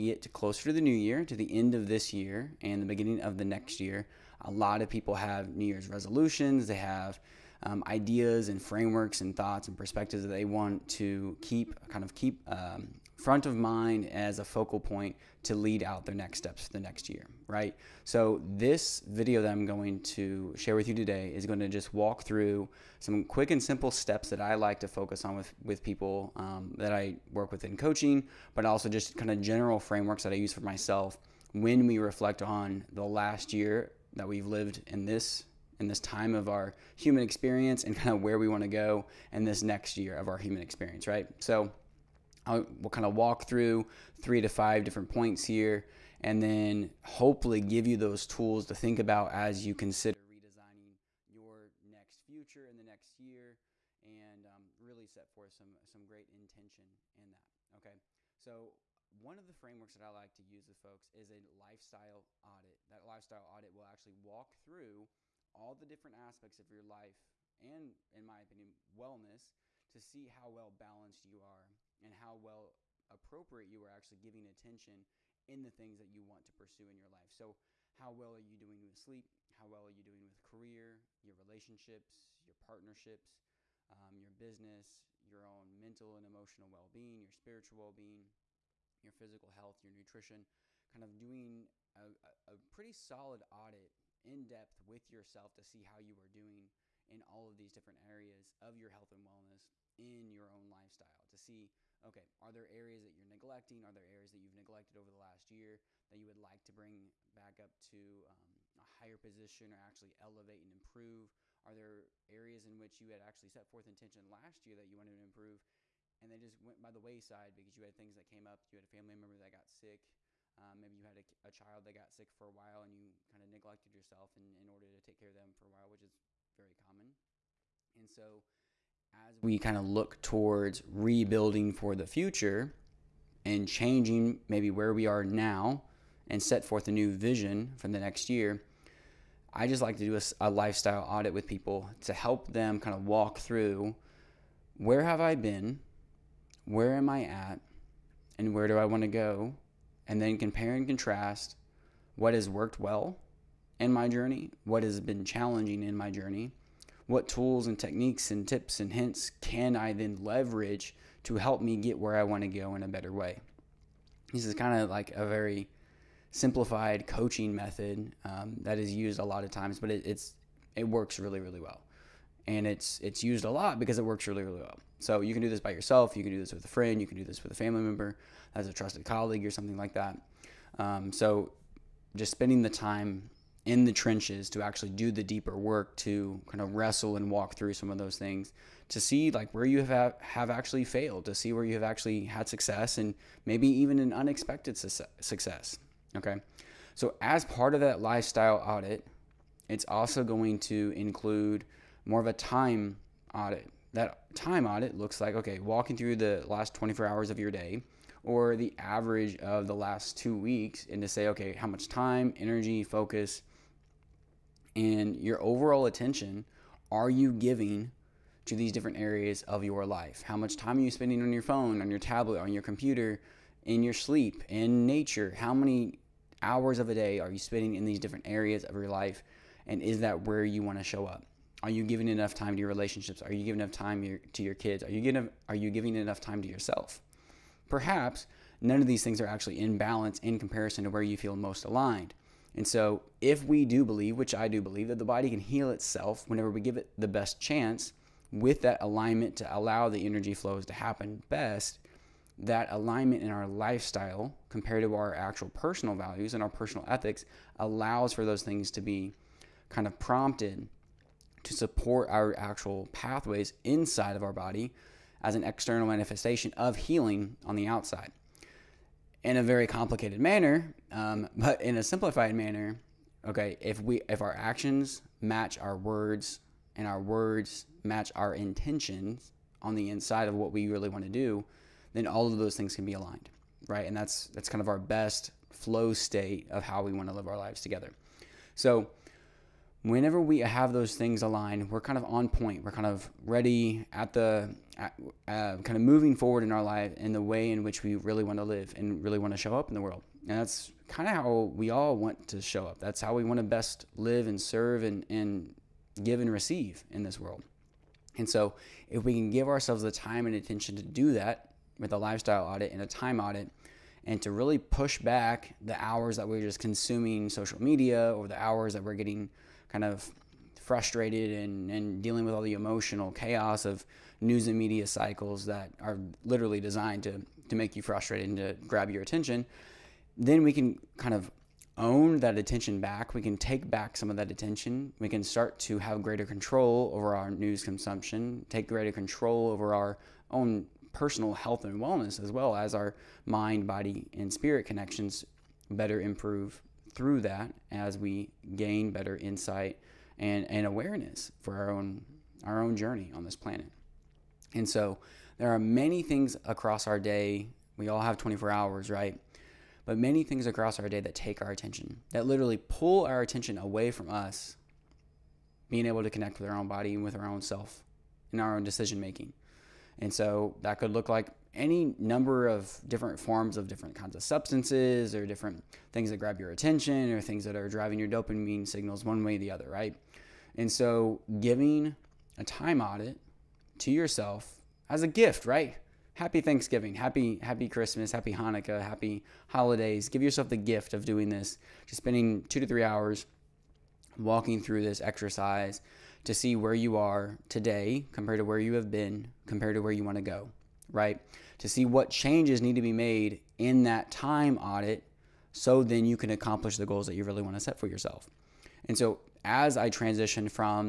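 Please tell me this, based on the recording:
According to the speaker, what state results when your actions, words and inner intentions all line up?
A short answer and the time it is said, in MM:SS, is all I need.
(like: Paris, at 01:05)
flow state, at 04:45.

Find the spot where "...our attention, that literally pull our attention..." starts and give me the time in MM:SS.
06:01.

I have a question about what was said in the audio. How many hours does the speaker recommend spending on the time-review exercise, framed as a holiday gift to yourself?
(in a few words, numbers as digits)
2 to 3 hours.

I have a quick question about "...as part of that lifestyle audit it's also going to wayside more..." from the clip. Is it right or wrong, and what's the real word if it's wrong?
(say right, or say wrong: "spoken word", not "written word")
wrong: "include", not "wayside".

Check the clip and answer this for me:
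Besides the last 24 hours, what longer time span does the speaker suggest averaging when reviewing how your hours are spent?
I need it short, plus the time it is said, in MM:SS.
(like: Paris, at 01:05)
two weeks, at 03:29.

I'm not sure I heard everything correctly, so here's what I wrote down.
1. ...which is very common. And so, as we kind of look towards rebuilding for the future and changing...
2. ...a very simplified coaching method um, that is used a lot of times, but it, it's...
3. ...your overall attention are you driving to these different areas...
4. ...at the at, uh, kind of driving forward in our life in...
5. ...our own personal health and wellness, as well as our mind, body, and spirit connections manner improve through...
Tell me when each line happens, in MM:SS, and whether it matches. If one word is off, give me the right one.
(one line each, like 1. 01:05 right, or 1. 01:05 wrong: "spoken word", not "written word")
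1. 02:05 right
2. 02:45 right
3. 03:35 wrong: "giving", not "driving"
4. 04:53 wrong: "moving", not "driving"
5. 05:39 wrong: "better", not "manner".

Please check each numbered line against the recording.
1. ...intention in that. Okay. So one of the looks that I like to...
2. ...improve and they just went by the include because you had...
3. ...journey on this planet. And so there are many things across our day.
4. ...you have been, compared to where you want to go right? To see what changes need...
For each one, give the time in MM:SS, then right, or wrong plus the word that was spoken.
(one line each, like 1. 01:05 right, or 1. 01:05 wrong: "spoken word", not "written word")
1. 00:56 wrong: "frameworks", not "looks"
2. 01:55 wrong: "wayside", not "include"
3. 05:52 right
4. 06:38 right.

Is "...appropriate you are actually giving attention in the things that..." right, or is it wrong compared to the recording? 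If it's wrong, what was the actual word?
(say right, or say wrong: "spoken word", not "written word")
right.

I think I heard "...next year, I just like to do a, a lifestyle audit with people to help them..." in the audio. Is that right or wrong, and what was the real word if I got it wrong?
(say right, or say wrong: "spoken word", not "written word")
right.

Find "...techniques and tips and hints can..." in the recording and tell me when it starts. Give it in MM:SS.
02:37.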